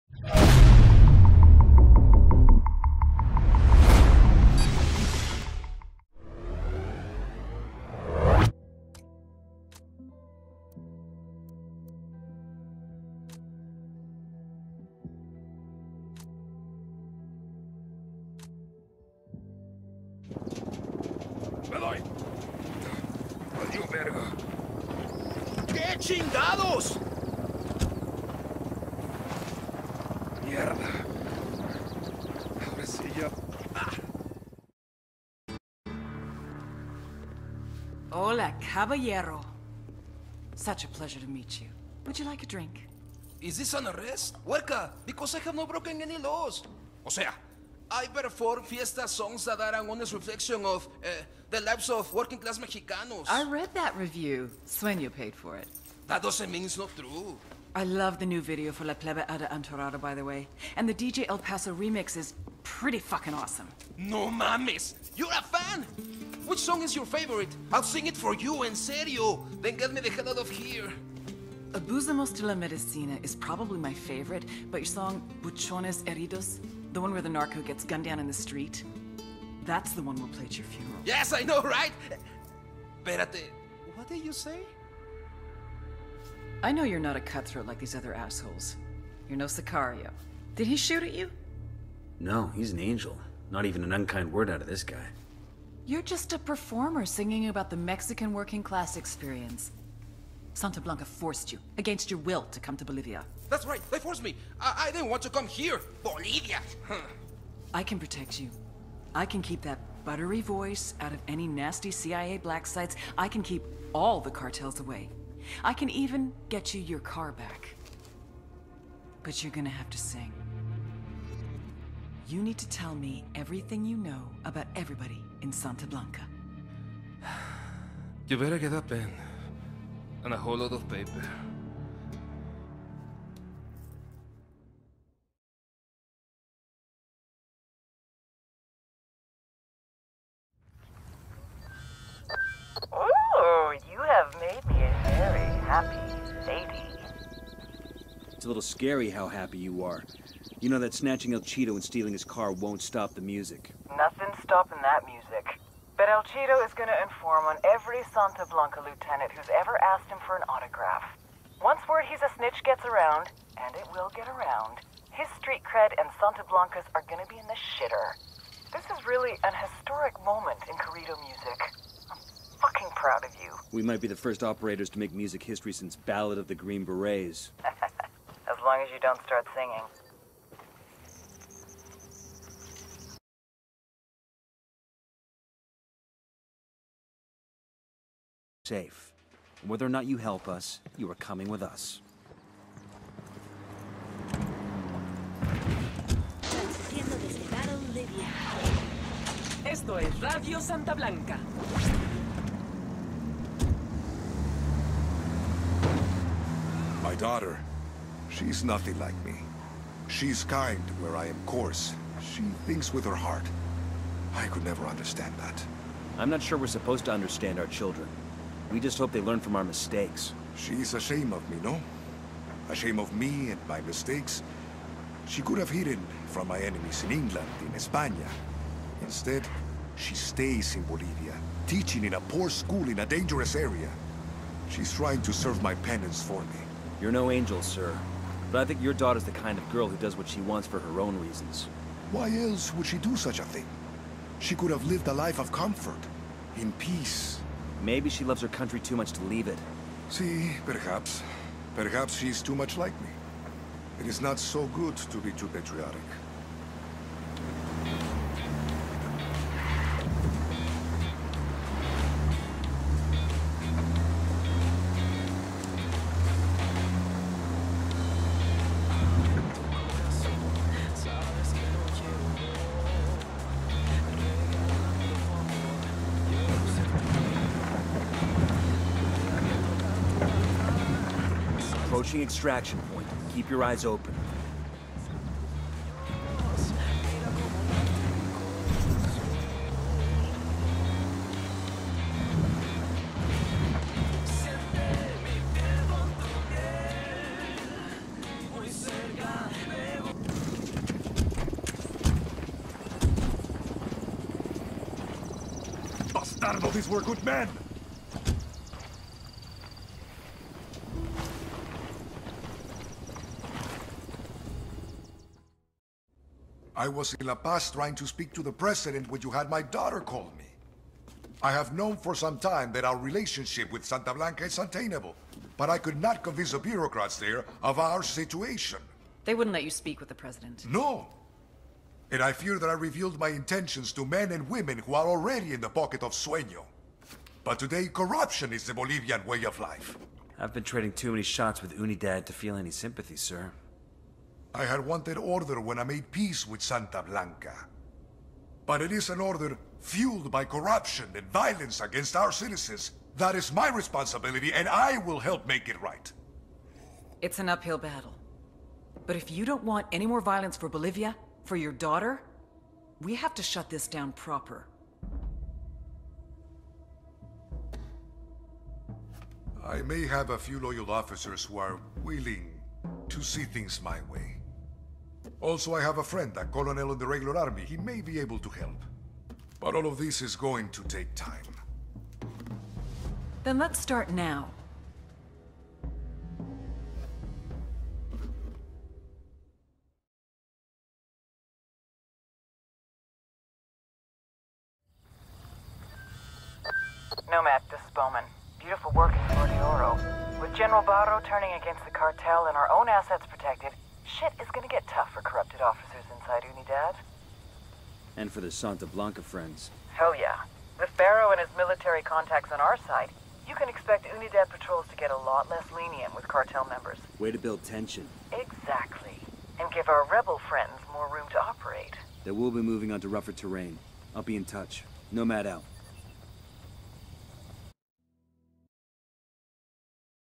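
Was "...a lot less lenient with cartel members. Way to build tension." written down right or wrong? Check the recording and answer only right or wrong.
right.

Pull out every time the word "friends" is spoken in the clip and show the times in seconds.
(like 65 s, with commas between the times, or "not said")
376 s, 409 s, 420 s.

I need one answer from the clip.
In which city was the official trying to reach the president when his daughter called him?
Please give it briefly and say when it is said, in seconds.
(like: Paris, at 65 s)
La Paz, at 317 s.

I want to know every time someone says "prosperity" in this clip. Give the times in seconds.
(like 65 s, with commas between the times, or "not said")
not said.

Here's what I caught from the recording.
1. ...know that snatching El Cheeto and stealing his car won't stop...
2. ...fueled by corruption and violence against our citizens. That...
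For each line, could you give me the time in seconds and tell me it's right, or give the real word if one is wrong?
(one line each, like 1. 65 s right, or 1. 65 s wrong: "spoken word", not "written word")
1. 150 s right
2. 349 s right.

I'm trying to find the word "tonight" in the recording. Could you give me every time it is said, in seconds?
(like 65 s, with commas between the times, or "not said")
not said.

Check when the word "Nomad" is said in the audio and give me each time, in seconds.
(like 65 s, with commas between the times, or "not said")
397 s, 425 s.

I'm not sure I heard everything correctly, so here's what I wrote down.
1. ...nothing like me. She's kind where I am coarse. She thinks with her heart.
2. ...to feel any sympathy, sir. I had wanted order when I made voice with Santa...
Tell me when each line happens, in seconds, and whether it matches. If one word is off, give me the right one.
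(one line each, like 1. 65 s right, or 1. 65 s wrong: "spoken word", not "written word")
1. 208 s right
2. 342 s wrong: "peace", not "voice".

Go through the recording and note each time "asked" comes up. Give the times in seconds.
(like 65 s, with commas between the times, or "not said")
159 s.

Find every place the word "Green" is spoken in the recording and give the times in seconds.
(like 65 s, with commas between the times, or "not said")
176 s.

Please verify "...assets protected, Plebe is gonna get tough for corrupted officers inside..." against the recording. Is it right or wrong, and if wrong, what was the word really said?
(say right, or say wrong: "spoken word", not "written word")
wrong: "Shit", not "Plebe".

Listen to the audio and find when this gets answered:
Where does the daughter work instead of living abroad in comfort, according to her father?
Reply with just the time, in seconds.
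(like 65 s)
232 s.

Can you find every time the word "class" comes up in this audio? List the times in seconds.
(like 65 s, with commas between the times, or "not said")
52 s, 98 s.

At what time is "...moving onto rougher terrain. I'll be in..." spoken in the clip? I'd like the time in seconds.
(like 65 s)
422 s.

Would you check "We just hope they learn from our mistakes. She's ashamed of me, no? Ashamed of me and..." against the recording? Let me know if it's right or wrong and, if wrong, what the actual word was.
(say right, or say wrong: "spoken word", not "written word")
right.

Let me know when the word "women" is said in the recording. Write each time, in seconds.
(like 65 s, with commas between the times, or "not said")
334 s.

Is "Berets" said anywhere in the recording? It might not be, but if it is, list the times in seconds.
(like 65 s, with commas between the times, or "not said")
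176 s.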